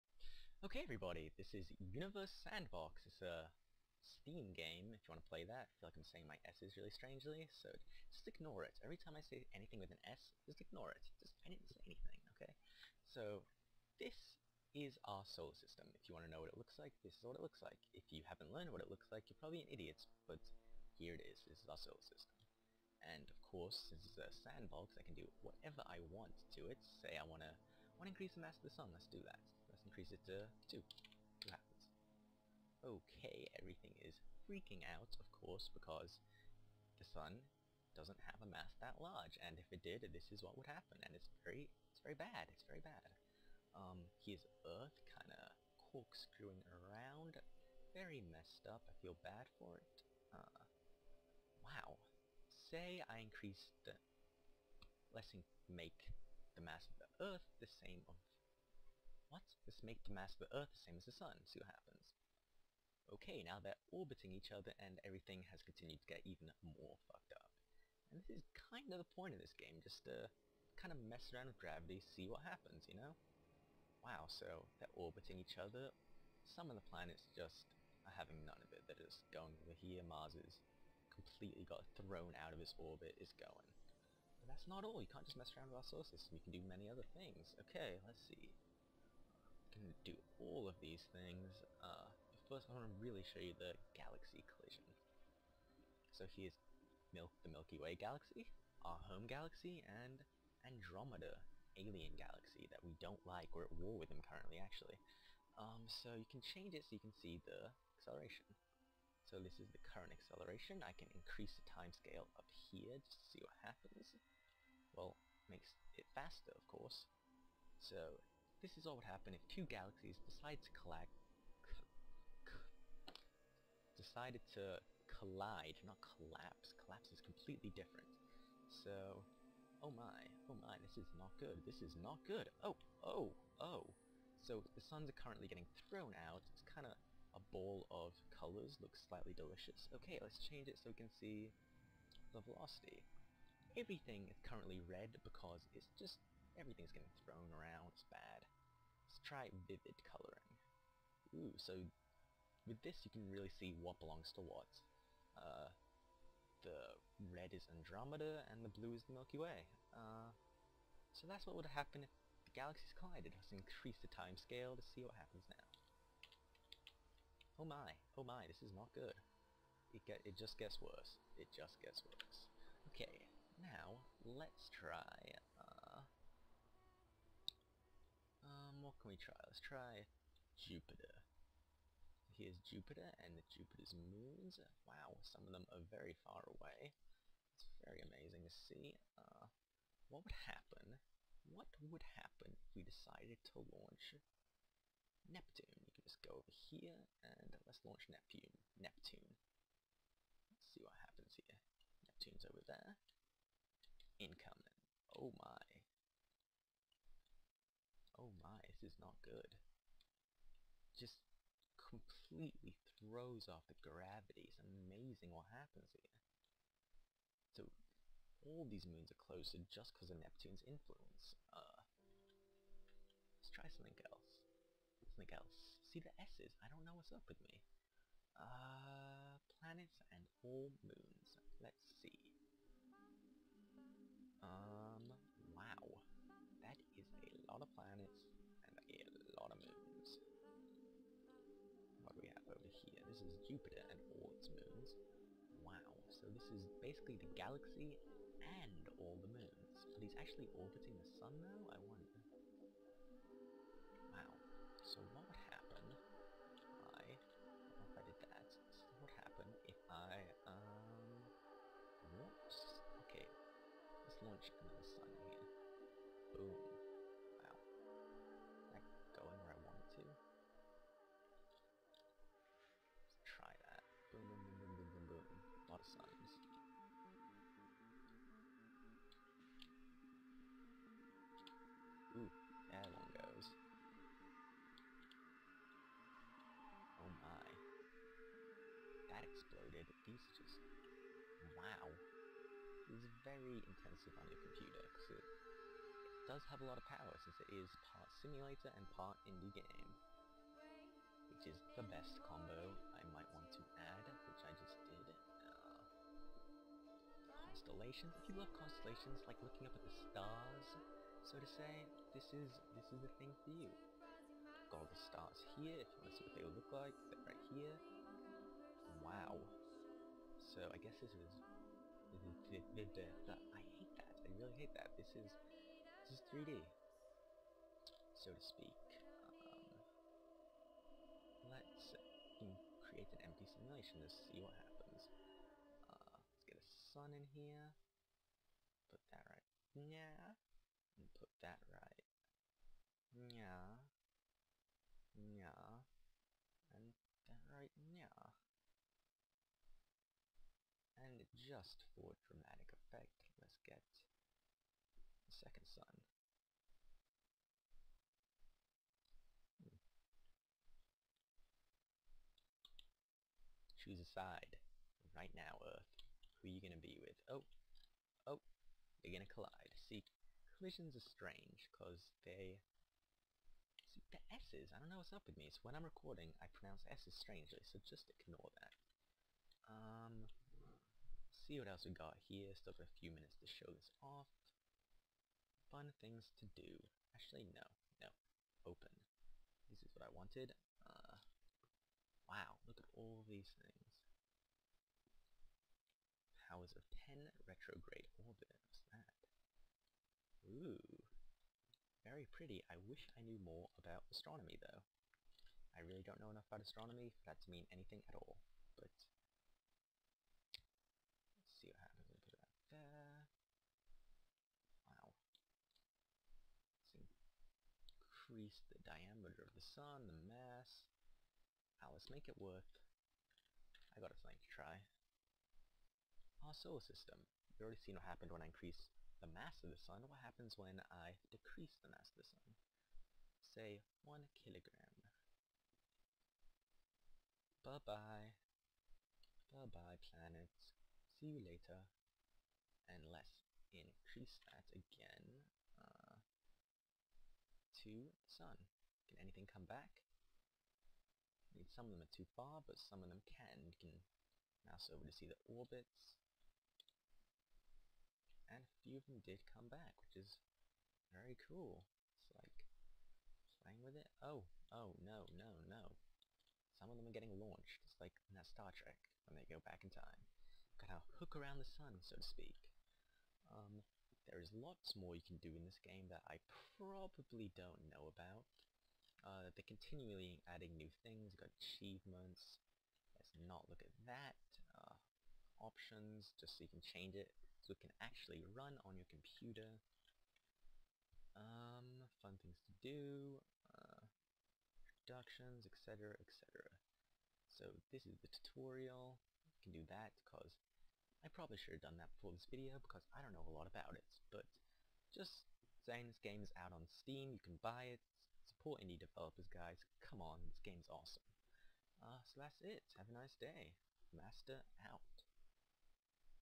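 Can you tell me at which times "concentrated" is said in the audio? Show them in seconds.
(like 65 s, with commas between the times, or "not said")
not said.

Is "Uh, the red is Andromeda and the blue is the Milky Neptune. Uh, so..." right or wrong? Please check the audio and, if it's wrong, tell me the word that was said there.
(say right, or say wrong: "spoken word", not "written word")
wrong: "Way", not "Neptune".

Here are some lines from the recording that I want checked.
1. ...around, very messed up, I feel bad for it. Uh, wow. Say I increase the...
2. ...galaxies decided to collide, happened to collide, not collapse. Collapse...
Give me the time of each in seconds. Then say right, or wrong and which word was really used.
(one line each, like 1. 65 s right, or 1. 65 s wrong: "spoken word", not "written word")
1. 46 s right
2. 119 s wrong: "decided", not "happened".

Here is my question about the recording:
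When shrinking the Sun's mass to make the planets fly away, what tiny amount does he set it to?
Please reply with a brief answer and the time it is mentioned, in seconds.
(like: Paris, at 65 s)
1 kilogram, at 434 s.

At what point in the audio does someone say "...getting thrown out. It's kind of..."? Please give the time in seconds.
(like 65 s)
135 s.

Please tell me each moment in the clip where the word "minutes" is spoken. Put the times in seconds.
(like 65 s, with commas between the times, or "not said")
383 s.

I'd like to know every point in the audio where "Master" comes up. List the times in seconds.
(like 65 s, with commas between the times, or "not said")
514 s.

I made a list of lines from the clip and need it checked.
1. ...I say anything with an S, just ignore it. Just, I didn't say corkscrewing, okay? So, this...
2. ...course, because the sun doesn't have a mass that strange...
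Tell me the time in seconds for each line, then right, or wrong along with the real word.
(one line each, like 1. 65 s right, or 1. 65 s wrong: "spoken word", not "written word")
1. 9 s wrong: "anything", not "corkscrewing"
2. 35 s wrong: "large", not "strange".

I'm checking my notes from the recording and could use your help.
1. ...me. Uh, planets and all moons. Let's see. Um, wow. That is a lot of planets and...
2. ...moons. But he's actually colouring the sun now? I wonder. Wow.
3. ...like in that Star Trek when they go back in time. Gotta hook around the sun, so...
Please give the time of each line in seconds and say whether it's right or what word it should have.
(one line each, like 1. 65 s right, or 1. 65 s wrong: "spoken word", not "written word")
1. 227 s right
2. 249 s wrong: "orbiting", not "colouring"
3. 467 s right.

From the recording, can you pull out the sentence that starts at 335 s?
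Uh, let's get a sun in here.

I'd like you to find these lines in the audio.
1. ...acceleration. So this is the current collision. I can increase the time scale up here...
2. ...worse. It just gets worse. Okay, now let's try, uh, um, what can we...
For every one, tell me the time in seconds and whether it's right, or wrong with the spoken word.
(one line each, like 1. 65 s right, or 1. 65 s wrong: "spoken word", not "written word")
1. 107 s wrong: "acceleration", not "collision"
2. 170 s right.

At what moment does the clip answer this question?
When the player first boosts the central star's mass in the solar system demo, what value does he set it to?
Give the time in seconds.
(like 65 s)
30 s.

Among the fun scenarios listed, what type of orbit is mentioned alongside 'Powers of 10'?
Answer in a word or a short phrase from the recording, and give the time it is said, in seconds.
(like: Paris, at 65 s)
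retrograde orbit, at 397 s.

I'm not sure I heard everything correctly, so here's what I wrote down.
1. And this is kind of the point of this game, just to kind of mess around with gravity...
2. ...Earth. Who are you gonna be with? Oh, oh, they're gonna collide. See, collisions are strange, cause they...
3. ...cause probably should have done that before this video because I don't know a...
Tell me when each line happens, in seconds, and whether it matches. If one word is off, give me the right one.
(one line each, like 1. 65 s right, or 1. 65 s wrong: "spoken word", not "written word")
1. 68 s right
2. 365 s right
3. 500 s right.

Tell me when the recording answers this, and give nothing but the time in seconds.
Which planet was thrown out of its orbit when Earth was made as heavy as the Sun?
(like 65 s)
80 s.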